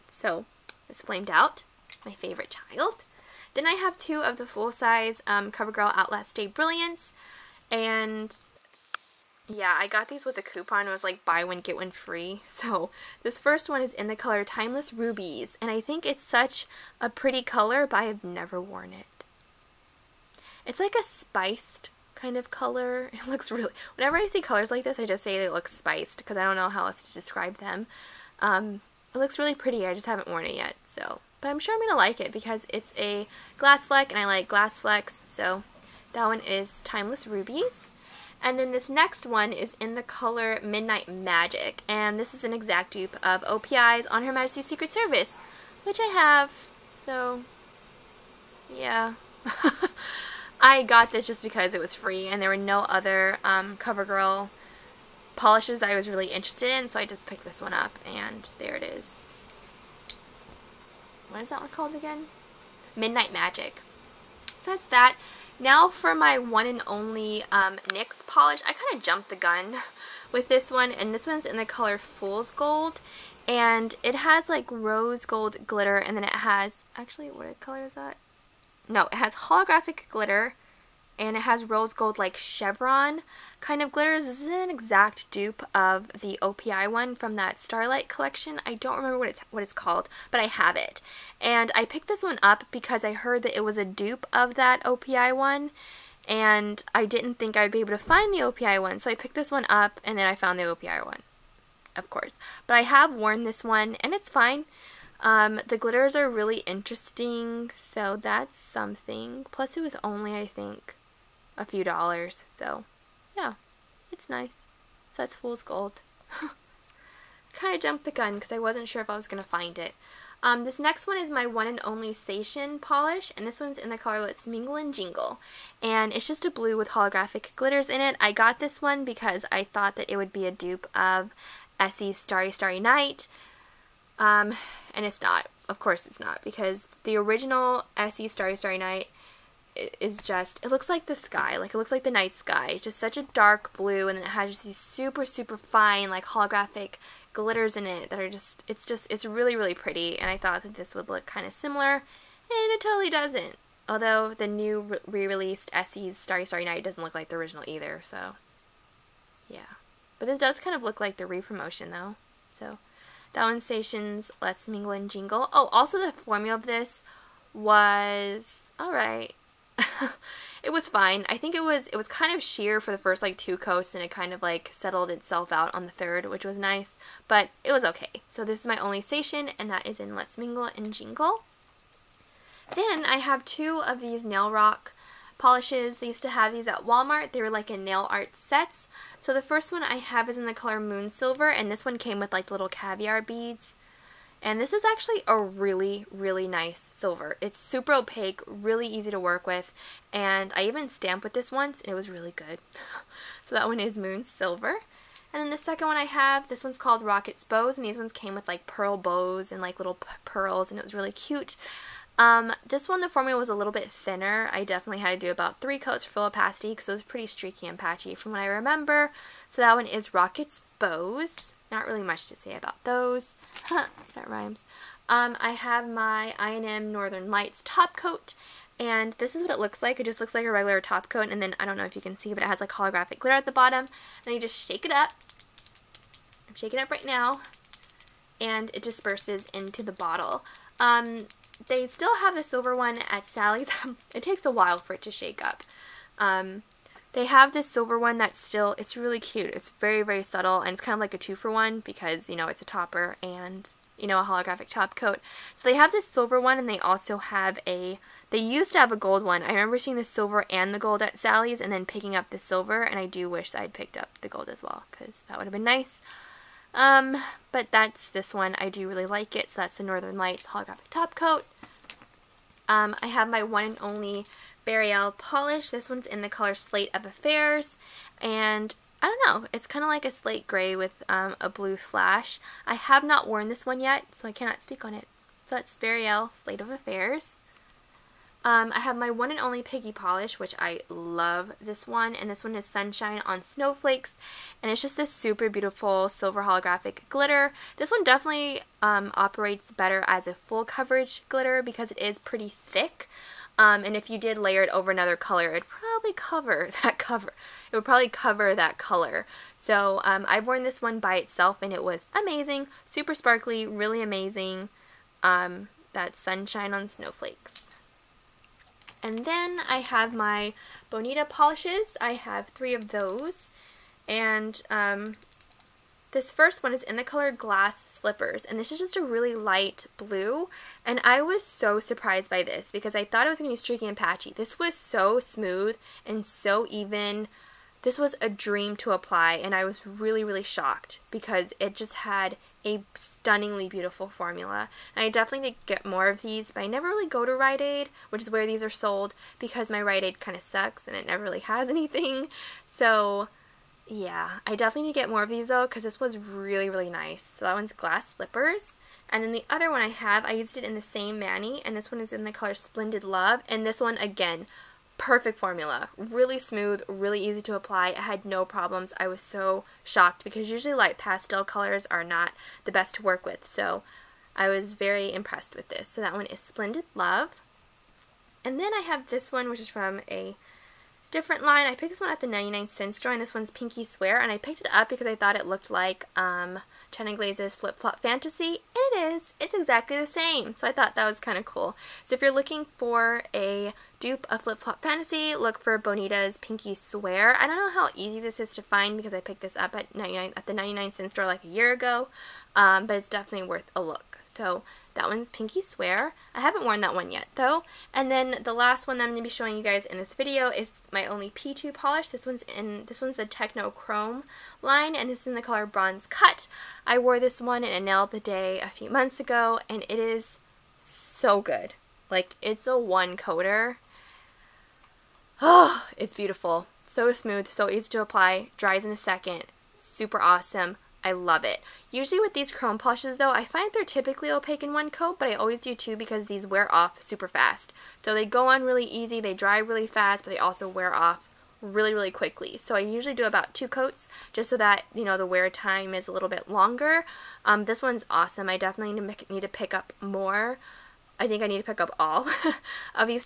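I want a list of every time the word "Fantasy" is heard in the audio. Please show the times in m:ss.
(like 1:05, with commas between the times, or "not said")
6:28, 6:34.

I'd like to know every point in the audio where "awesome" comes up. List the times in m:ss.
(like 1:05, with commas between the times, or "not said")
7:10, 7:28.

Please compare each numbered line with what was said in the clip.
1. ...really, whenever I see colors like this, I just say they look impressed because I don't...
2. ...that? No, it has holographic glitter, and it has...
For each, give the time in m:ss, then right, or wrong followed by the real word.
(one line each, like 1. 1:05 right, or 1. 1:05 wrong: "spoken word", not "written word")
1. 0:23 wrong: "spiced", not "impressed"
2. 1:17 right.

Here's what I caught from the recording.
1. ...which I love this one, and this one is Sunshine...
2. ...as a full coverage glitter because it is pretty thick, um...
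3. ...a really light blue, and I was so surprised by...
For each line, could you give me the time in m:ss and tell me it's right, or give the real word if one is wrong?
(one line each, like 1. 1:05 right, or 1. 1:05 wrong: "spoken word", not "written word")
1. 4:50 right
2. 5:00 right
3. 5:28 right.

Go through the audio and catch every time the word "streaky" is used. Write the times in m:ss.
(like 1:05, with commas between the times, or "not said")
3:37, 5:33.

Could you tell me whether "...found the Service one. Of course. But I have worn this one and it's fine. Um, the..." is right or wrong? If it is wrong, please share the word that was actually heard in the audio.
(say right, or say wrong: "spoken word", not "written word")
wrong: "OPI", not "Service".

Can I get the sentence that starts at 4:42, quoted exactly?
I have not worn this one yet, so I cannot speak on it.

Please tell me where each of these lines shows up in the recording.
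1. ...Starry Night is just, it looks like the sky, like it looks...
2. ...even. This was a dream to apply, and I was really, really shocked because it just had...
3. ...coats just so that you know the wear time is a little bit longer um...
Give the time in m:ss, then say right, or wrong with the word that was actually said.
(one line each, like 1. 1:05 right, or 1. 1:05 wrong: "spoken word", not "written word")
1. 2:18 right
2. 5:36 right
3. 7:23 right.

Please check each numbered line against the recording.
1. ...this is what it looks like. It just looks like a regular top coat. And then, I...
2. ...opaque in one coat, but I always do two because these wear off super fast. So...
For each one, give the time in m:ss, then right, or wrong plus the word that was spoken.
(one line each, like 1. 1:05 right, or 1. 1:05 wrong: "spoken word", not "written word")
1. 3:49 right
2. 7:14 right.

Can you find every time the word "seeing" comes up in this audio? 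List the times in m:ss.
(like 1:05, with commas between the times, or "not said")
4:19.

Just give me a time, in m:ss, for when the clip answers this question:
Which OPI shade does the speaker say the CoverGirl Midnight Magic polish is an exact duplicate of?
0:44.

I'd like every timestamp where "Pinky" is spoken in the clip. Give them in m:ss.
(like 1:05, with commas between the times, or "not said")
6:23, 6:36, 6:45.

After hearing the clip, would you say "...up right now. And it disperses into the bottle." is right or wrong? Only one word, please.
right.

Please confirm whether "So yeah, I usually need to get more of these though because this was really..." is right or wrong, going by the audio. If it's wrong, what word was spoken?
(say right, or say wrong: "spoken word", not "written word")
wrong: "definitely", not "usually".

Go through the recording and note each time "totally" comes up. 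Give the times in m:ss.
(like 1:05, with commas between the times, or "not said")
2:32.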